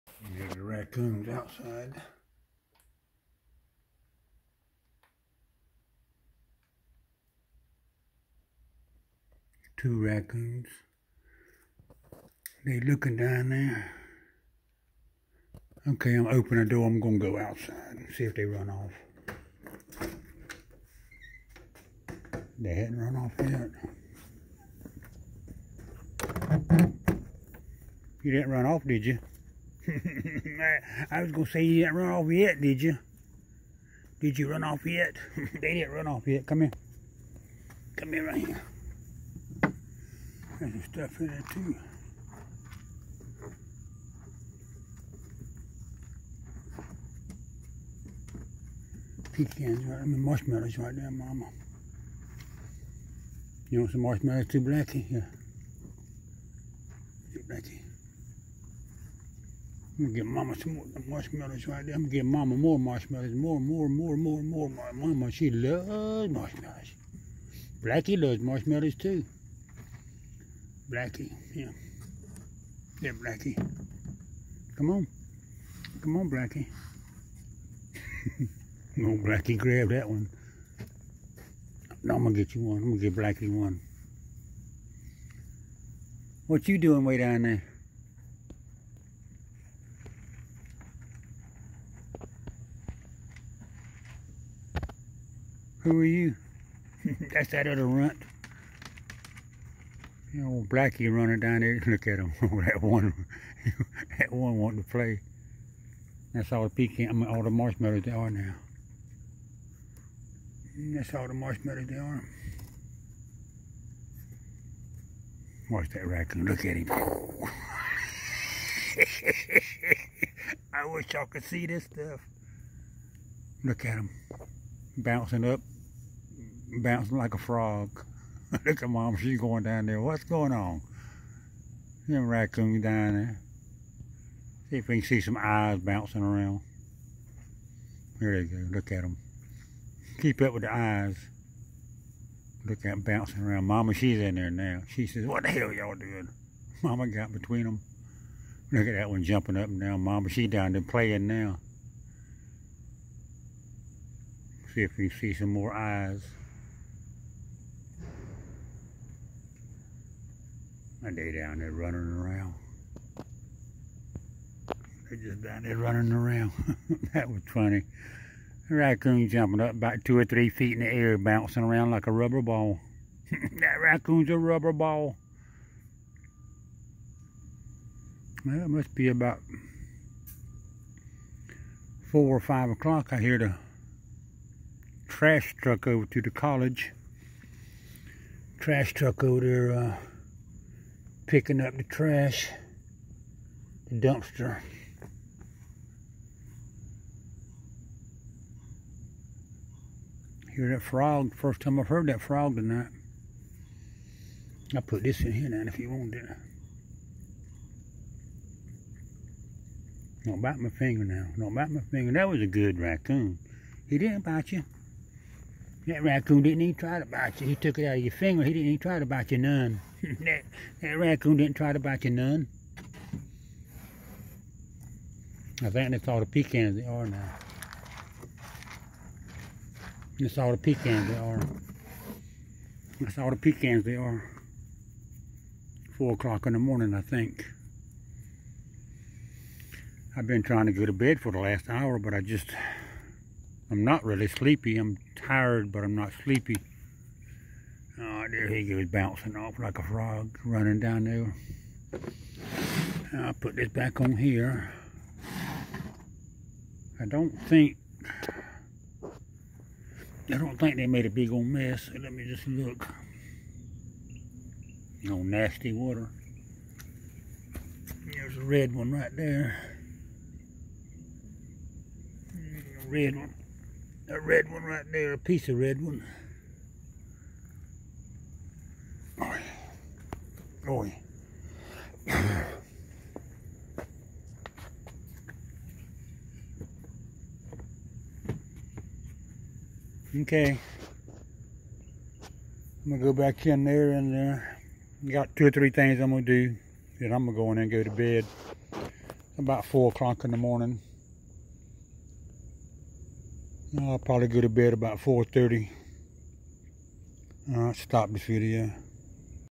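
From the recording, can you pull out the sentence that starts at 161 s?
My day down there running around.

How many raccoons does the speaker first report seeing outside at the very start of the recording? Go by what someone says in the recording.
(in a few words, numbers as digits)
2.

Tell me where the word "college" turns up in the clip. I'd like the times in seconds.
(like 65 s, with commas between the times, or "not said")
186 s.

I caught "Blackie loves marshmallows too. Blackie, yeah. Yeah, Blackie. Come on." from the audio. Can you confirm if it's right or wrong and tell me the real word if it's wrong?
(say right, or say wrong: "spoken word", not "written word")
right.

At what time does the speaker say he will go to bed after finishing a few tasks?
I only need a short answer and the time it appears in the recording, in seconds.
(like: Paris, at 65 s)
4:30, at 304 s.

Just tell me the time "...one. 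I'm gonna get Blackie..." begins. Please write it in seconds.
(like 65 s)
82 s.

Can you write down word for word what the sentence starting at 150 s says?
Mama, she down there playing now.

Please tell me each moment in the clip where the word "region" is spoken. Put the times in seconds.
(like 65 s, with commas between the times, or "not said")
not said.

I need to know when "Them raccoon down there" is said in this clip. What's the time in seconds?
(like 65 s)
132 s.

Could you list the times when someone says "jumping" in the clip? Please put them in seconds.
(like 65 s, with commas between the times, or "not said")
149 s, 169 s.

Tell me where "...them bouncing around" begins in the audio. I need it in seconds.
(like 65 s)
142 s.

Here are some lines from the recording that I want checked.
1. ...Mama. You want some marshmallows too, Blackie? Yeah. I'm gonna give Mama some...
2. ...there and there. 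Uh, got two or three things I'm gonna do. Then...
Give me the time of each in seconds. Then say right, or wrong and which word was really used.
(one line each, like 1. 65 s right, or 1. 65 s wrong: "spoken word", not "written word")
1. 51 s right
2. 293 s right.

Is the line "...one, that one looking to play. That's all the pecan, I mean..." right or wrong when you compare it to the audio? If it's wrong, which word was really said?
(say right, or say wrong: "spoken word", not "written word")
wrong: "wanting", not "looking".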